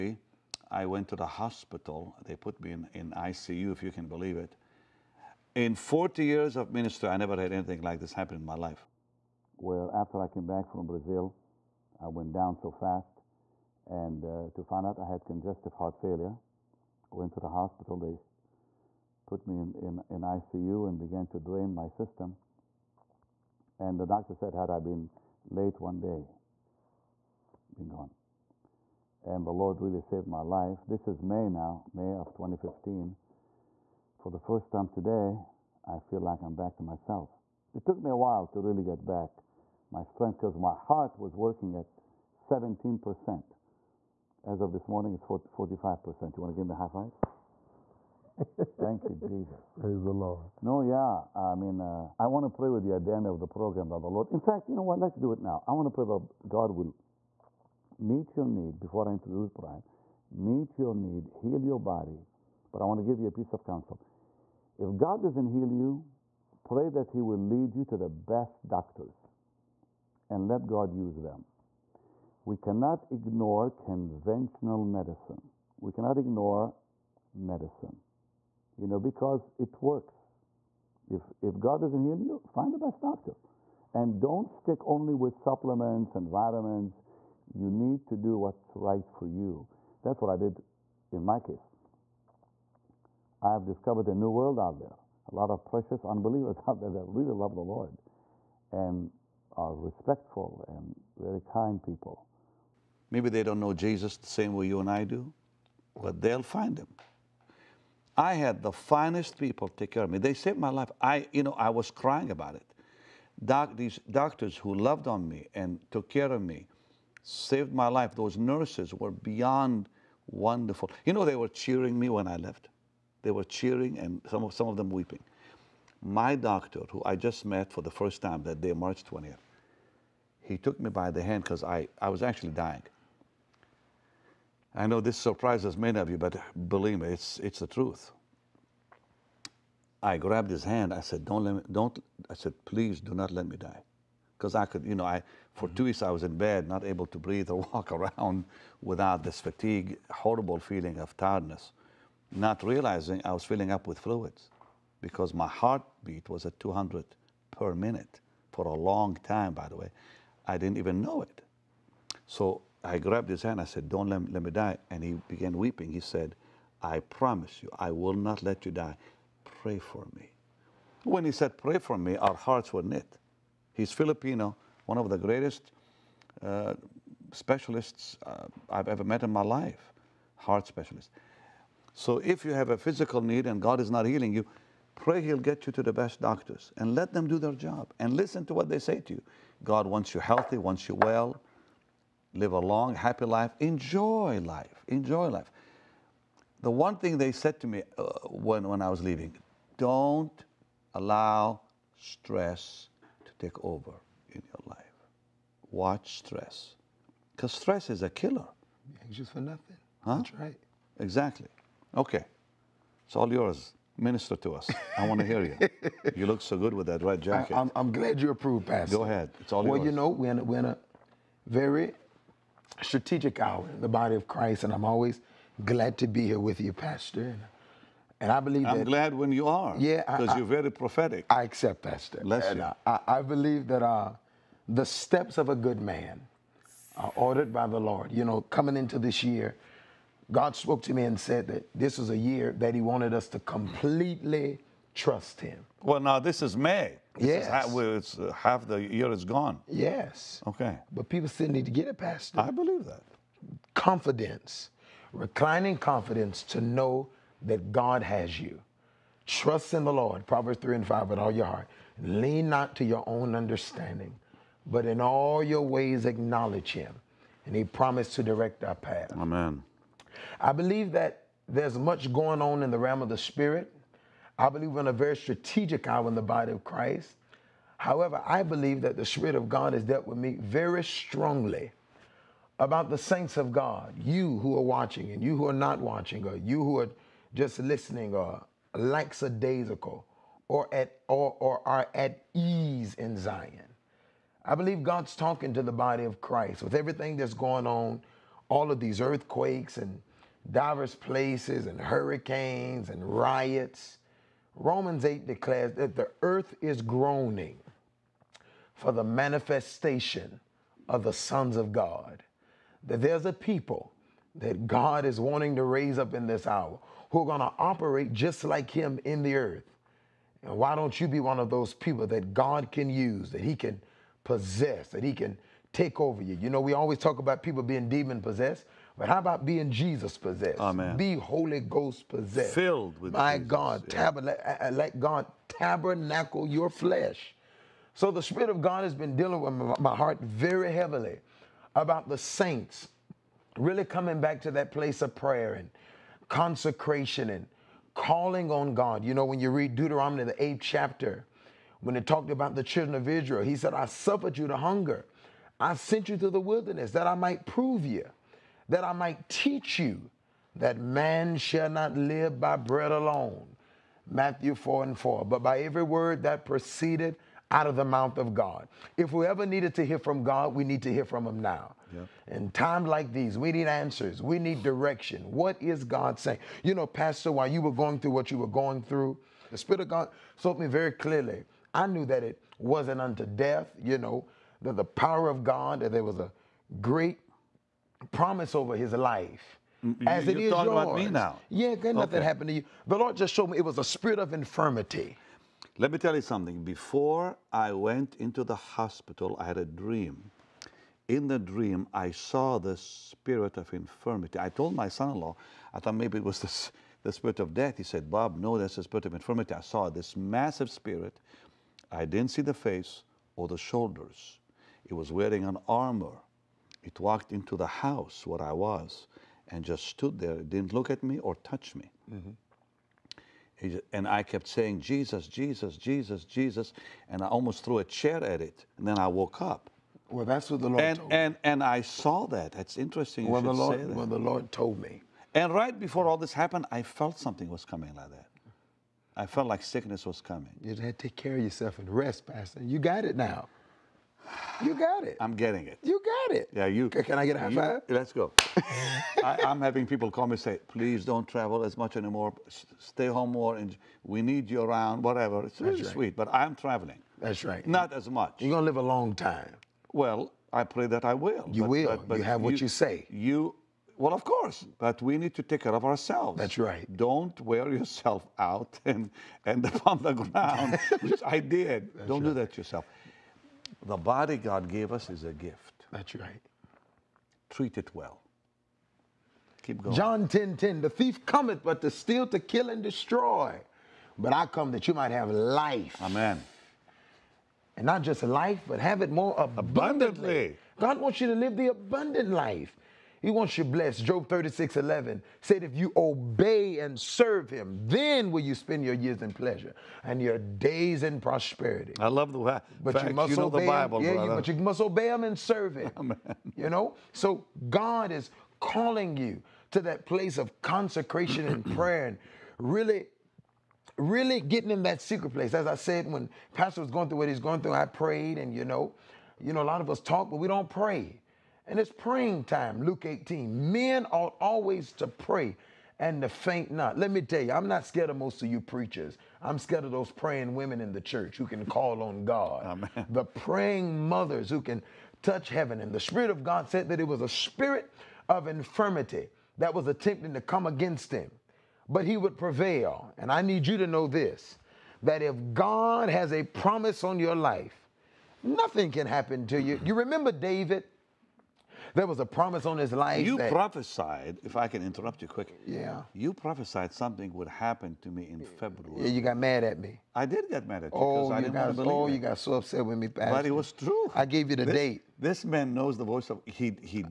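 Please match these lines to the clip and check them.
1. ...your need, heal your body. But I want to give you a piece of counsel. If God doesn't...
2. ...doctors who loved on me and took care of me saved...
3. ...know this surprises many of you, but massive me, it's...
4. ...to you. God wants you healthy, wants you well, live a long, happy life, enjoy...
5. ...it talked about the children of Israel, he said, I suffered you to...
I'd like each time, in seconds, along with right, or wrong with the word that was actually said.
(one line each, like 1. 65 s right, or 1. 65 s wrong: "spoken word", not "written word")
1. 60 s right
2. 114 s right
3. 134 s wrong: "believe", not "massive"
4. 189 s right
5. 351 s right.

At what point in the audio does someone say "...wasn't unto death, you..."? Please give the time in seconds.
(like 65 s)
382 s.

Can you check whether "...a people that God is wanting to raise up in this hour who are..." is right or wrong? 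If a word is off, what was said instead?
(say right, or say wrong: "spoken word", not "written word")
right.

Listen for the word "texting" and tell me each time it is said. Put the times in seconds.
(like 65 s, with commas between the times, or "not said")
not said.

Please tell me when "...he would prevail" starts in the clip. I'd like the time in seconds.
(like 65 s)
542 s.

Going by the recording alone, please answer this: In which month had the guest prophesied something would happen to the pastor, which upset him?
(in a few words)
February.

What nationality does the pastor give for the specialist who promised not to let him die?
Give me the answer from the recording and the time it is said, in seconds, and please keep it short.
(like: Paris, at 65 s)
Filipino, at 173 s.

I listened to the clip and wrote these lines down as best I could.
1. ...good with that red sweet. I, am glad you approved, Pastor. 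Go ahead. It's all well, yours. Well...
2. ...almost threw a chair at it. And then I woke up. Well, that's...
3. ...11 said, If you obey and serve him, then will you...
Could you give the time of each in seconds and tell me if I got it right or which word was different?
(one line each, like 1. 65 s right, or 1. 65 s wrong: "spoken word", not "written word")
1. 216 s wrong: "jacket", not "sweet"
2. 427 s right
3. 494 s right.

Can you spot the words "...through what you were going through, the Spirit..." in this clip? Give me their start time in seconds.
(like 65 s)
377 s.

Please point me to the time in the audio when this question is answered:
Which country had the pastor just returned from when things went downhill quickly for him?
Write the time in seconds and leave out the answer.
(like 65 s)
10 s.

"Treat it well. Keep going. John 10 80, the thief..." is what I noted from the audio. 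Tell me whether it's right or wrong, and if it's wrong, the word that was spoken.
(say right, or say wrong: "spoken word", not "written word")
wrong: "10", not "80".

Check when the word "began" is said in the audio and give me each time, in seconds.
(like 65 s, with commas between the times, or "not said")
20 s, 165 s.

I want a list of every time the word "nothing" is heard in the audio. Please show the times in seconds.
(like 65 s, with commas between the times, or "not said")
209 s, 391 s, 548 s.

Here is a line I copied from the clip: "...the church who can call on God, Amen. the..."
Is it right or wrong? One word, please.
right.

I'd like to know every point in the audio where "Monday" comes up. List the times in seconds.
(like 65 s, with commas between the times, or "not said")
not said.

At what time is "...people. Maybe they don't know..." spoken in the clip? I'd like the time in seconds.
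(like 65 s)
101 s.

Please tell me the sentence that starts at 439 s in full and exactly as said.
I felt like sickness was coming.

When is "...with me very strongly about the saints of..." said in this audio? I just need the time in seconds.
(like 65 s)
280 s.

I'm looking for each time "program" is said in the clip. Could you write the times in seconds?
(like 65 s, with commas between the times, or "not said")
53 s.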